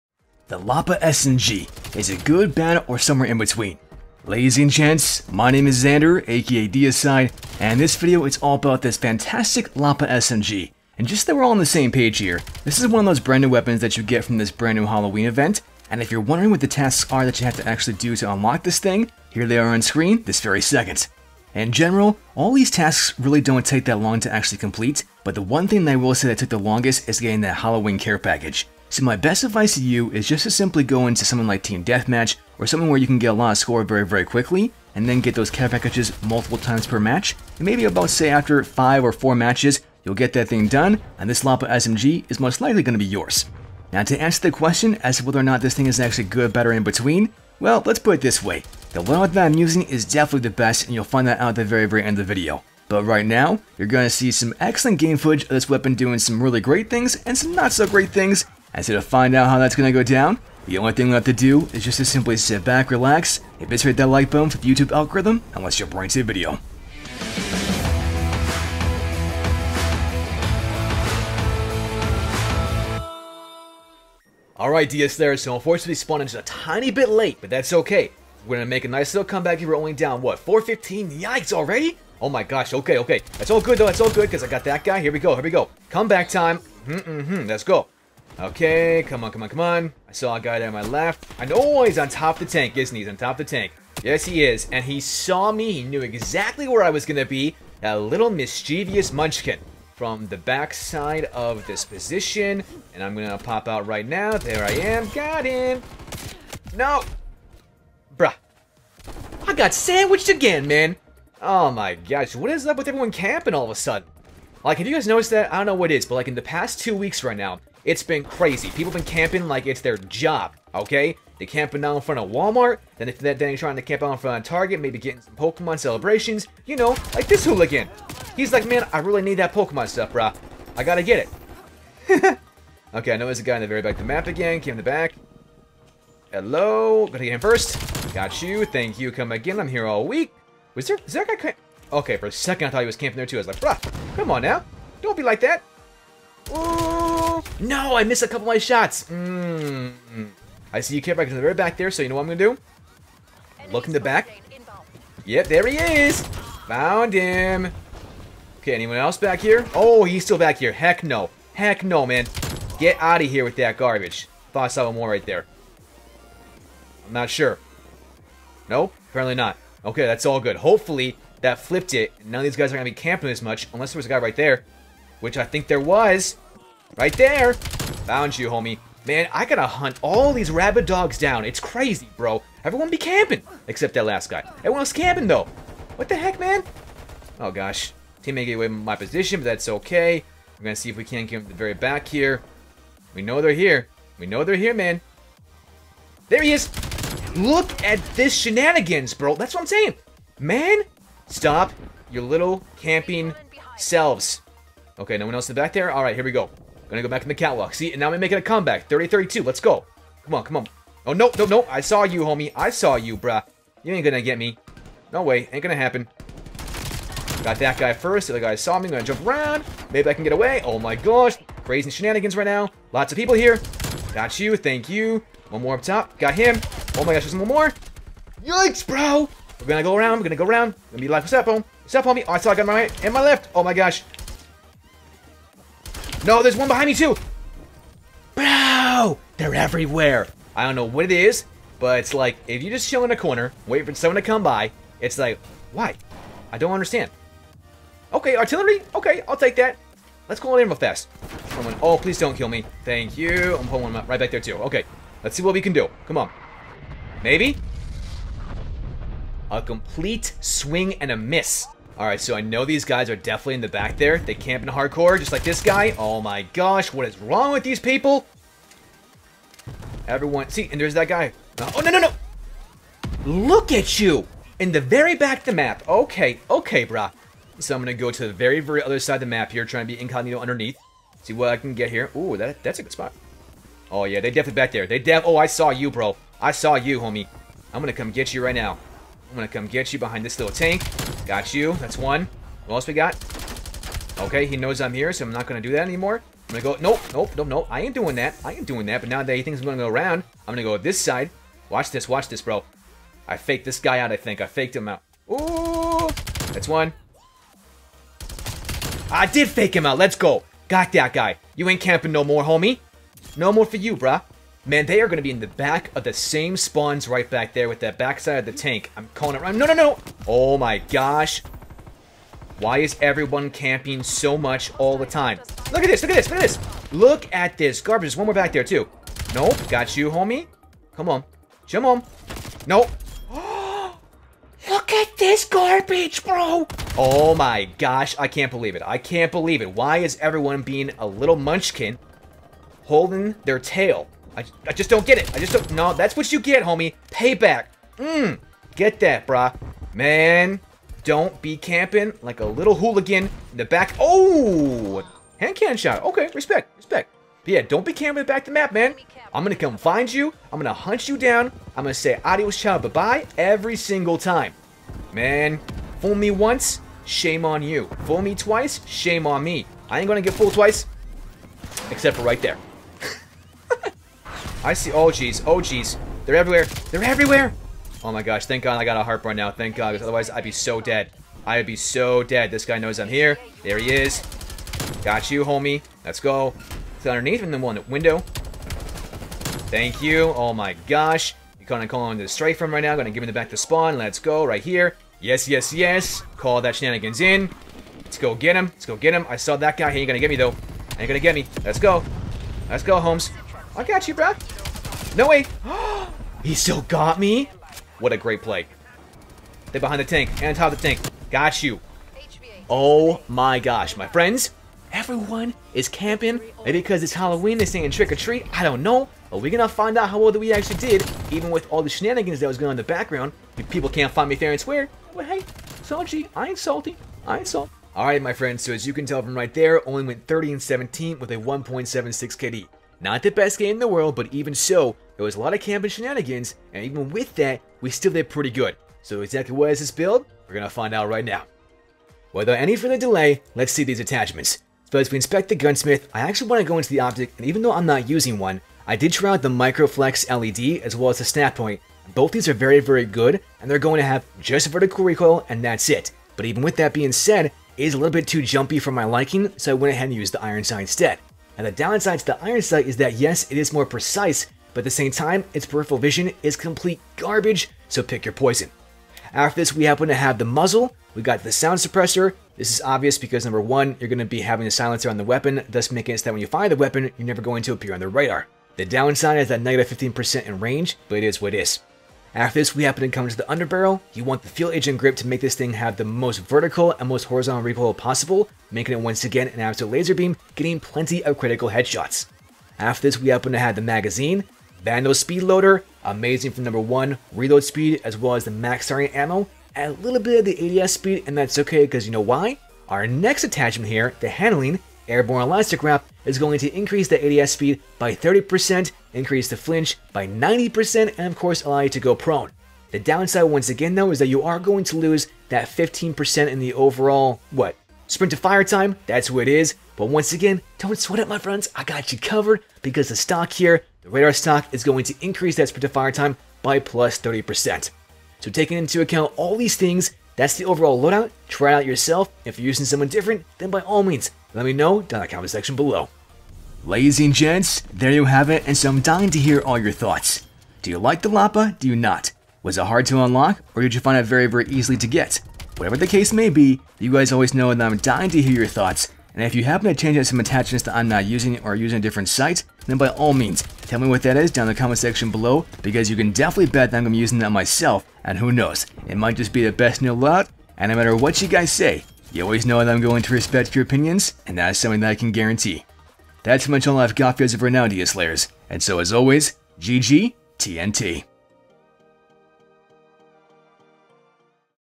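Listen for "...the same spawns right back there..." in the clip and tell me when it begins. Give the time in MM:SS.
05:16.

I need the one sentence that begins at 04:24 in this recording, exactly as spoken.
They camping hardcore, just like this guy.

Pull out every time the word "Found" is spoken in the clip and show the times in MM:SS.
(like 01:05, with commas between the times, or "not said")
02:36, 02:58.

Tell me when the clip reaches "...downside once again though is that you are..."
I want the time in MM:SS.
08:32.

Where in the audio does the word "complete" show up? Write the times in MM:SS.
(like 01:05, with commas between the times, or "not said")
00:24, 04:19, 07:46.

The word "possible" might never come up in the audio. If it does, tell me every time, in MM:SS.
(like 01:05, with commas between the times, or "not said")
08:07.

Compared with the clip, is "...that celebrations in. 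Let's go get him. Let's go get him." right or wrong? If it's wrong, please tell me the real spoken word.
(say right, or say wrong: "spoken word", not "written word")
wrong: "shenanigans", not "celebrations".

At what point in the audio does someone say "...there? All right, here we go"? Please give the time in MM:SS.
03:25.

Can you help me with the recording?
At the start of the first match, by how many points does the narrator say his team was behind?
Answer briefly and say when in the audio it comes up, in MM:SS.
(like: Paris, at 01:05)
415, at 01:20.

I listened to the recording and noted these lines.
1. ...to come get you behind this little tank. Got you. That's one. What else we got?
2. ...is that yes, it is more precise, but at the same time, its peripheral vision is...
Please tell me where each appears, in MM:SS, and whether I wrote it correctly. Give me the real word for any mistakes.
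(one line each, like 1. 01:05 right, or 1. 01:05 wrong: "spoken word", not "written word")
1. 04:49 right
2. 07:42 right.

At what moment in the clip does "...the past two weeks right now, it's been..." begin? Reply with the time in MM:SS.
01:56.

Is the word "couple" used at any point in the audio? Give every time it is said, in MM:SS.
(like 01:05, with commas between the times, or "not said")
02:28.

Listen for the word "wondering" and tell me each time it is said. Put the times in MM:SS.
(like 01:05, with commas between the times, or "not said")
00:16.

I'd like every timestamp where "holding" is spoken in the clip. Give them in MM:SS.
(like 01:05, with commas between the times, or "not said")
05:42.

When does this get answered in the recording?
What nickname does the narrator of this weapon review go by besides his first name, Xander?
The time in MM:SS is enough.
00:06.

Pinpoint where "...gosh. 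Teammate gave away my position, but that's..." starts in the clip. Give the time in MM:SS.
03:07.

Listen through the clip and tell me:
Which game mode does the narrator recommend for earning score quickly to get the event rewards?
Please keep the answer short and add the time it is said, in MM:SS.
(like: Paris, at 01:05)
Team Deathmatch, at 00:31.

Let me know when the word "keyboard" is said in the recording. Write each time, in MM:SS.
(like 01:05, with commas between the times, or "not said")
not said.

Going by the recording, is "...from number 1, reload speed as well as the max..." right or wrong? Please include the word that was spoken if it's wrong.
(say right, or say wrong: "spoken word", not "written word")
right.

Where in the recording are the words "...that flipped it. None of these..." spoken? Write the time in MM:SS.
02:51.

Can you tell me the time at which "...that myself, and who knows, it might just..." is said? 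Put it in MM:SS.
09:17.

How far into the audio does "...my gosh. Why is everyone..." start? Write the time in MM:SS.
05:20.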